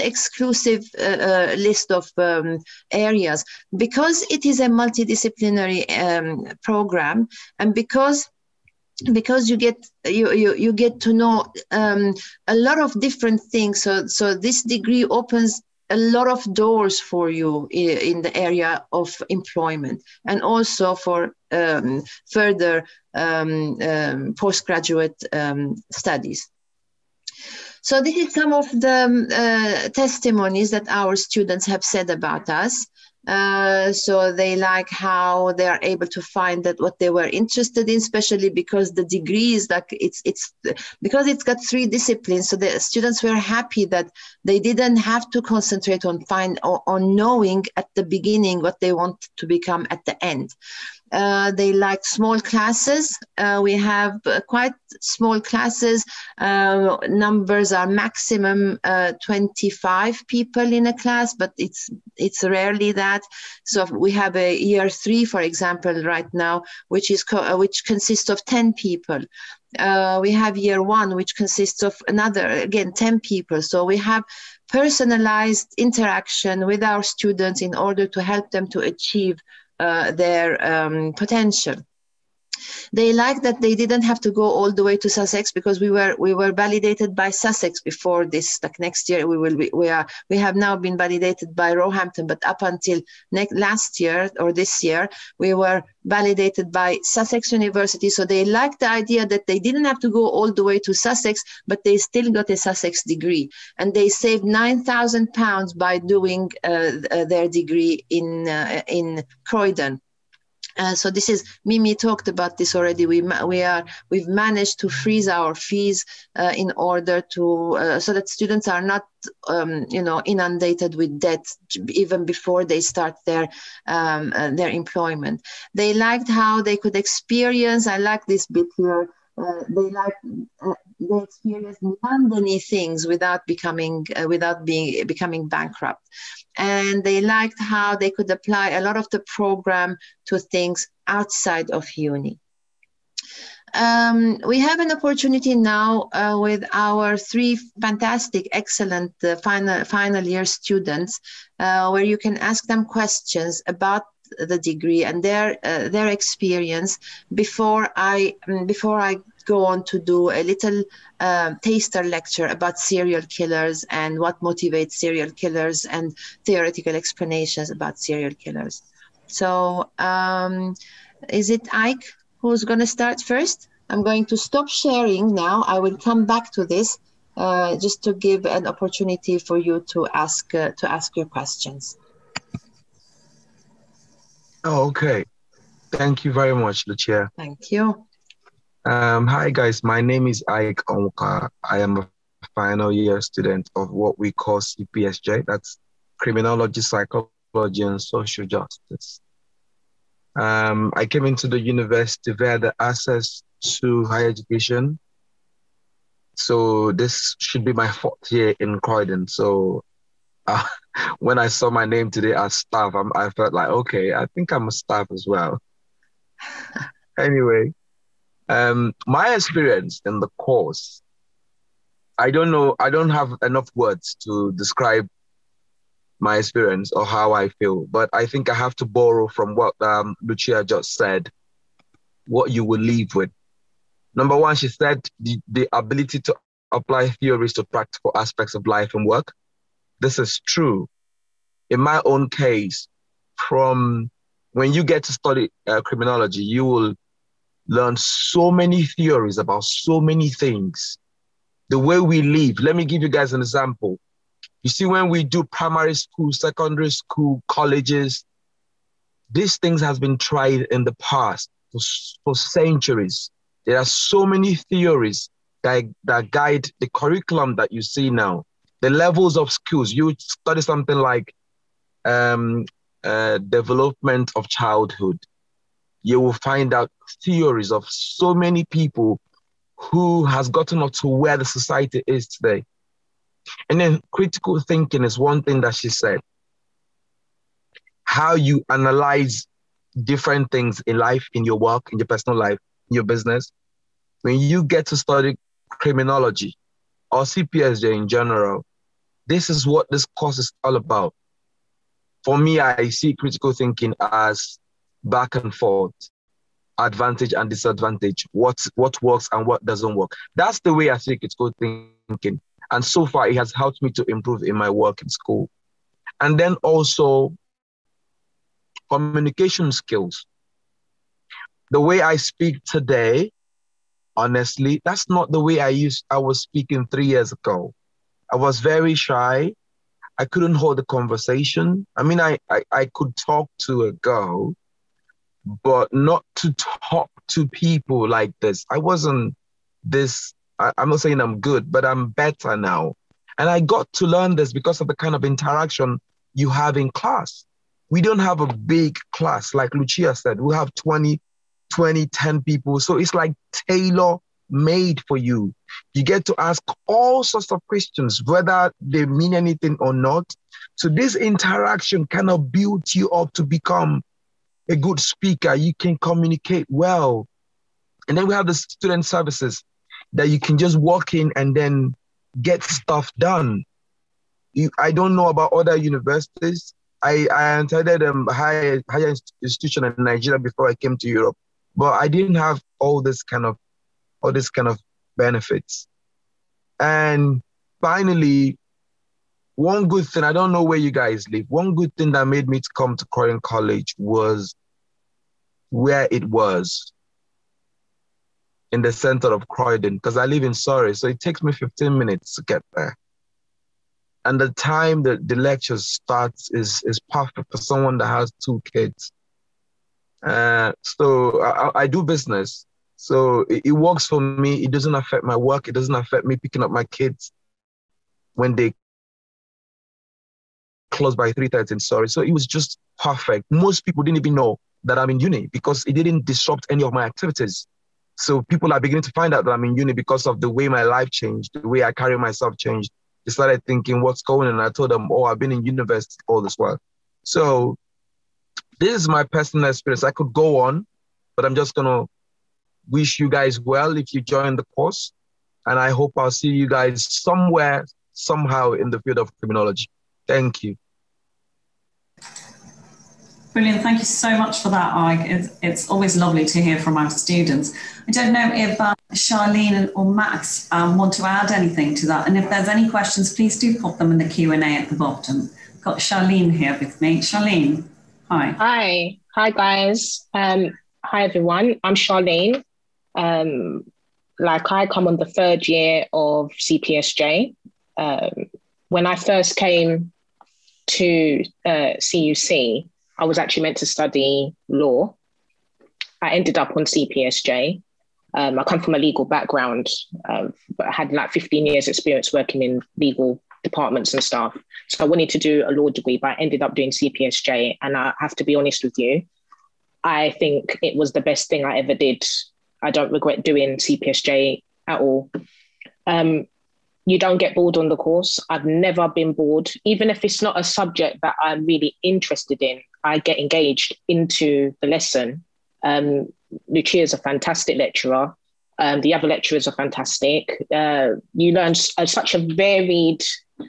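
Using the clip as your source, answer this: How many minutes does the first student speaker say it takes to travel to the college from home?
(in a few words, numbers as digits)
15.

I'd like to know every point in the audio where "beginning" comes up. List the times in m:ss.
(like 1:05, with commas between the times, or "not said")
0:48, 7:08.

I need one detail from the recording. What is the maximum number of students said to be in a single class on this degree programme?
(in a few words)
25.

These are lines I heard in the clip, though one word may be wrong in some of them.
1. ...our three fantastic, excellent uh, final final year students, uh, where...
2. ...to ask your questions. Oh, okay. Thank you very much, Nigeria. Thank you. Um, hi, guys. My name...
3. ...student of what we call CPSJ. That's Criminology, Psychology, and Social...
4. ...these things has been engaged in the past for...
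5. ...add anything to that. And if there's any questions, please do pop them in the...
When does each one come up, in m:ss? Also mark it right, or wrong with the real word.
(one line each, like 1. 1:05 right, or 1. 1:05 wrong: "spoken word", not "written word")
1. 2:26 right
2. 3:00 wrong: "Lucia", not "Nigeria"
3. 3:13 right
4. 4:19 wrong: "tried", not "engaged"
5. 7:41 right.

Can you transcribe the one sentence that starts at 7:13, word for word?
They started thinking, what's going on?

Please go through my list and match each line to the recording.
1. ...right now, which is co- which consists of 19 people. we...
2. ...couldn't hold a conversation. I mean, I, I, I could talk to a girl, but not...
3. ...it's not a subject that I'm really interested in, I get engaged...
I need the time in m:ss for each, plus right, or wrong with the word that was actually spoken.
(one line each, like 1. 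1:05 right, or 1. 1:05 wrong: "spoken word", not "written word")
1. 1:06 wrong: "10", not "19"
2. 5:30 right
3. 8:30 right.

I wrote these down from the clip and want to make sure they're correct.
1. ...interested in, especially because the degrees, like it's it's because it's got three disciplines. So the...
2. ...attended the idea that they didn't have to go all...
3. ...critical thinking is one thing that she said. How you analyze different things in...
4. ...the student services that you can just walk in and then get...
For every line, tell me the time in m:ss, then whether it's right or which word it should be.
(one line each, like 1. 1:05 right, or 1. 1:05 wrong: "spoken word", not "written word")
1. 0:37 right
2. 1:38 wrong: "liked", not "attended"
3. 4:44 right
4. 6:08 right.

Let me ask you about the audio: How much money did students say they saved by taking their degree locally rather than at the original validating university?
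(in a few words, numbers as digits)
9,000 pounds.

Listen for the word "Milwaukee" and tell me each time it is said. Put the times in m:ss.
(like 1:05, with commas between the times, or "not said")
not said.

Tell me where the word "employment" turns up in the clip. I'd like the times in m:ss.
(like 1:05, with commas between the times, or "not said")
0:19, 2:04.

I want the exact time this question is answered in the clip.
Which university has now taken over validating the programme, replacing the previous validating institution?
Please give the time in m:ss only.
1:31.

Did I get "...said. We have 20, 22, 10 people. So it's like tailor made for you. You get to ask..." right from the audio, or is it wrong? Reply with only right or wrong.
wrong.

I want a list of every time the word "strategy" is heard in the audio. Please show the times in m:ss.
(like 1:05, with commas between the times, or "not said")
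not said.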